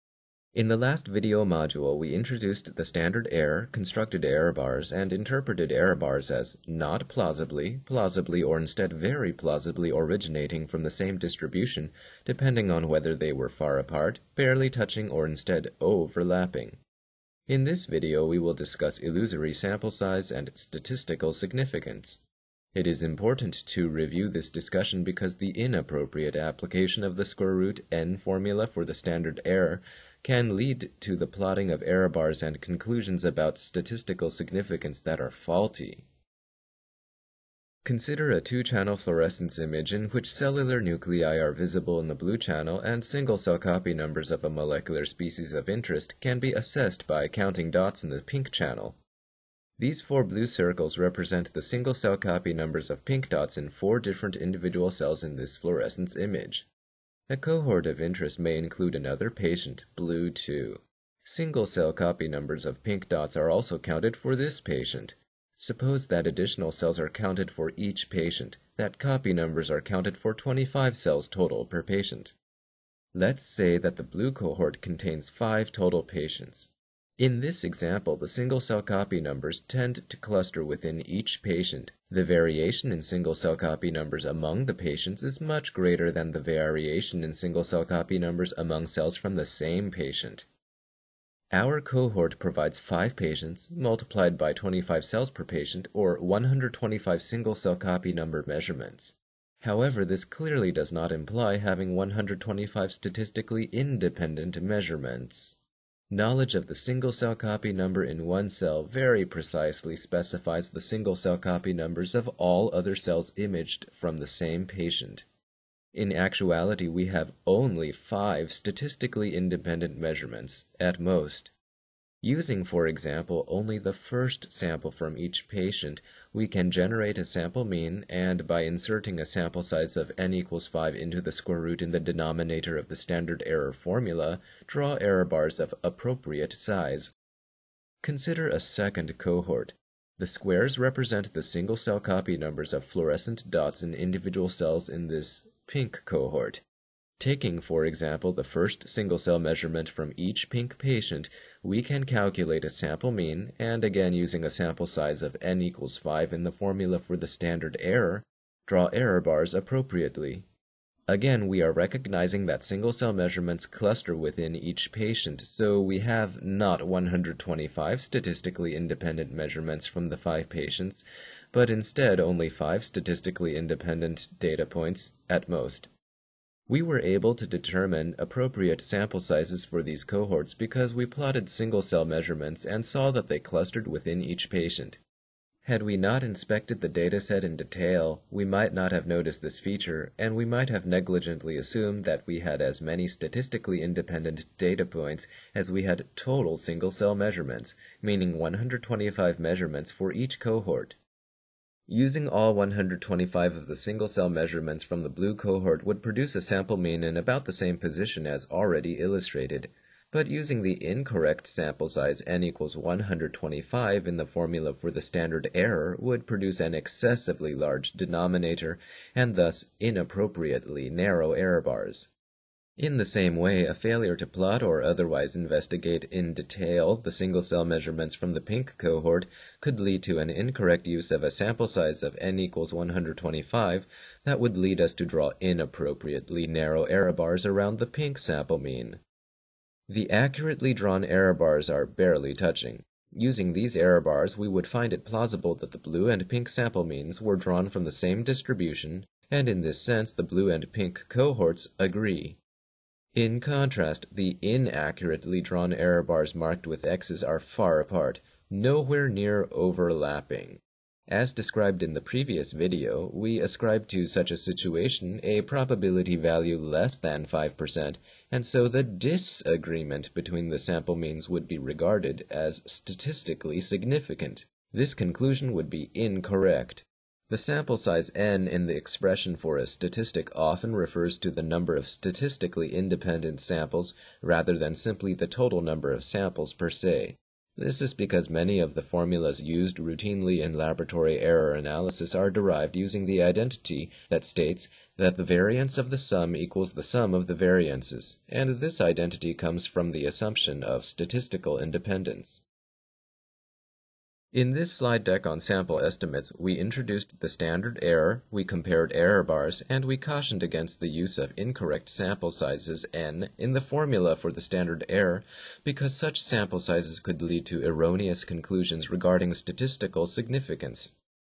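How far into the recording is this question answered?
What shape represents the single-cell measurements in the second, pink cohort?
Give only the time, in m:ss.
2:20.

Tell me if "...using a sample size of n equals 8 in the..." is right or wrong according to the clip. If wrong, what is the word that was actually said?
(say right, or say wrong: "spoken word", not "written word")
wrong: "5", not "8".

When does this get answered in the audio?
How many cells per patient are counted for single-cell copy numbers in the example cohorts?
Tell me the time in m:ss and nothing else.
1:10.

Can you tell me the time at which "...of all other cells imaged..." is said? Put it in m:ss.
1:52.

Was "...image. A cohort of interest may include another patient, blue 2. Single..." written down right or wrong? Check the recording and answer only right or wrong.
right.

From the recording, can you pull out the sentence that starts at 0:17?
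In this video, we will discuss illusory sample size and statistical significance.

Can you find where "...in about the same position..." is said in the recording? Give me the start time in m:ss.
3:27.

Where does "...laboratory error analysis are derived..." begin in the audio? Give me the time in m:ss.
4:50.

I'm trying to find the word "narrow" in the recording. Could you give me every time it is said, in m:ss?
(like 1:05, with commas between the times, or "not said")
3:40, 3:56.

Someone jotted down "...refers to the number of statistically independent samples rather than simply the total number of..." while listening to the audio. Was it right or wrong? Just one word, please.
right.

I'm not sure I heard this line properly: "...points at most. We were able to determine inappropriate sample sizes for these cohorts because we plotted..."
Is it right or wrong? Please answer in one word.
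wrong.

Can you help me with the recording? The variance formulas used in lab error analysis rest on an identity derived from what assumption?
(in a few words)
statistical independence.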